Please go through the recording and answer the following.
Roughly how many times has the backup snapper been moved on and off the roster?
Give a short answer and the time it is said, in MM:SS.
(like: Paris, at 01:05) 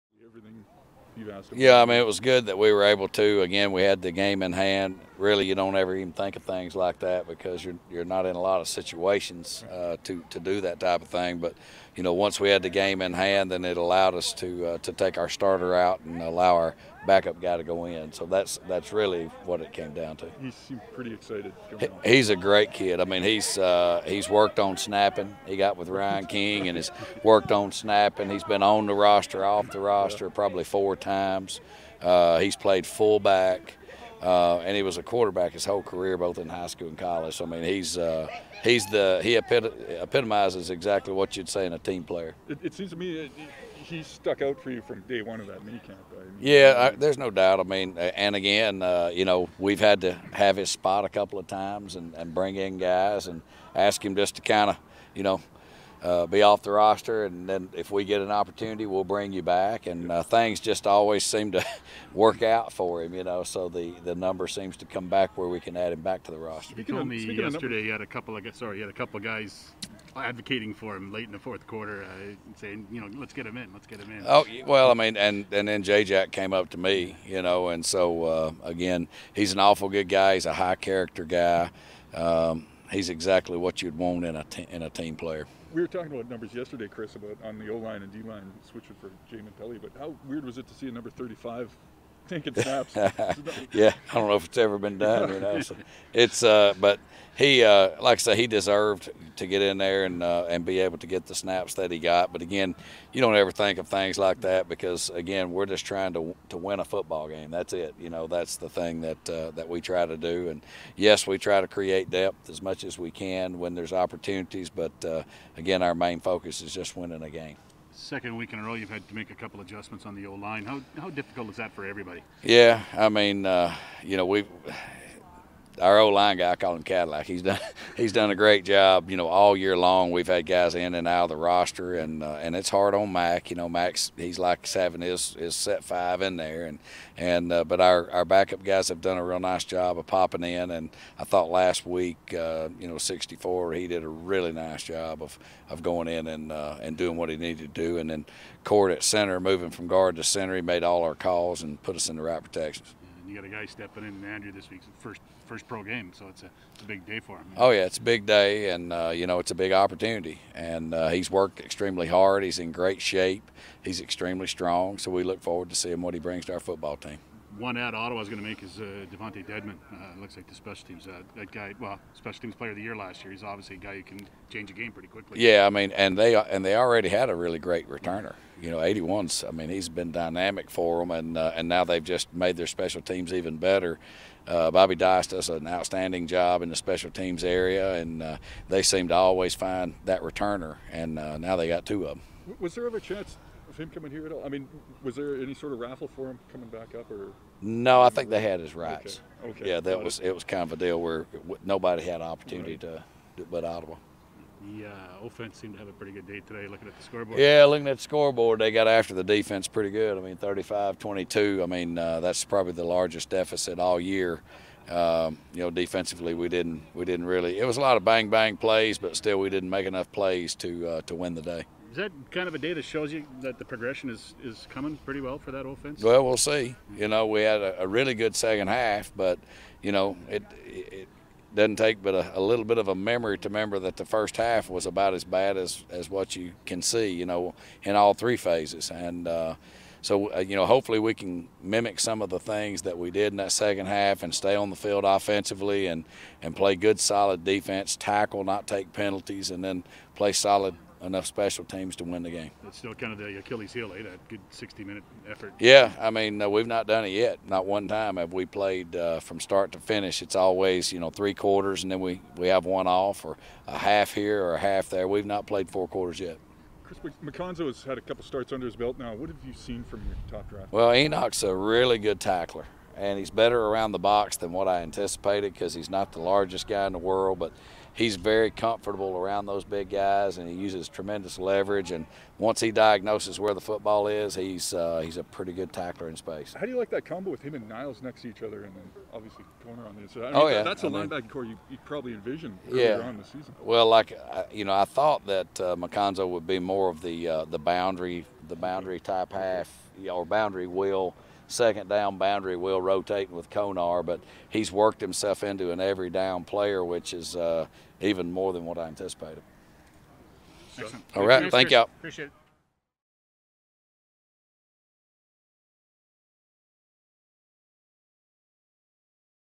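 4, at 00:30.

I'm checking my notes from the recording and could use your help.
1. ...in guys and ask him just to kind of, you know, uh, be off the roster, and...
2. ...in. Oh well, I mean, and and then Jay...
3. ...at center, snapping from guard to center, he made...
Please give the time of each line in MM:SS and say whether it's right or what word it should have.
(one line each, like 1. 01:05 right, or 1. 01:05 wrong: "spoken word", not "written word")
1. 00:52 right
2. 01:14 right
3. 02:28 wrong: "moving", not "snapping".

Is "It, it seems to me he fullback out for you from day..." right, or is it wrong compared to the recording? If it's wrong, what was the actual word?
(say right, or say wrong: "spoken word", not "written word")
wrong: "stuck", not "fullback".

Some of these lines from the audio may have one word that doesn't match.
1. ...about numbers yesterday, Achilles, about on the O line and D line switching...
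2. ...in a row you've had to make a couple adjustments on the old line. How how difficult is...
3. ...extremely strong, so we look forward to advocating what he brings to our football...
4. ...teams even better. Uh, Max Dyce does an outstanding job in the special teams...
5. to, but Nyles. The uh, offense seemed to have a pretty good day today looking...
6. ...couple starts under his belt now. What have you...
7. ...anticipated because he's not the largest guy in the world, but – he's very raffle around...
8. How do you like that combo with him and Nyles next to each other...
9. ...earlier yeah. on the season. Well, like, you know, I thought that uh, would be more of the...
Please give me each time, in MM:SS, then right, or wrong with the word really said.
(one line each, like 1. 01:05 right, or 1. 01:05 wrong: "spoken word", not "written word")
1. 01:26 wrong: "Chris", not "Achilles"
2. 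01:58 right
3. 02:44 wrong: "seeing", not "advocating"
4. 03:03 wrong: "Bobby", not "Max"
5. 03:23 wrong: "Ottawa", not "Nyles"
6. 04:28 right
7. 04:34 wrong: "comfortable", not "raffle"
8. 04:46 right
9. 04:52 right.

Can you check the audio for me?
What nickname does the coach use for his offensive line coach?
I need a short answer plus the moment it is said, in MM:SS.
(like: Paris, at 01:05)
Cadillac, at 02:06.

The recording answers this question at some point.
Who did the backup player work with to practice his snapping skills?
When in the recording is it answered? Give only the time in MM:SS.
00:25.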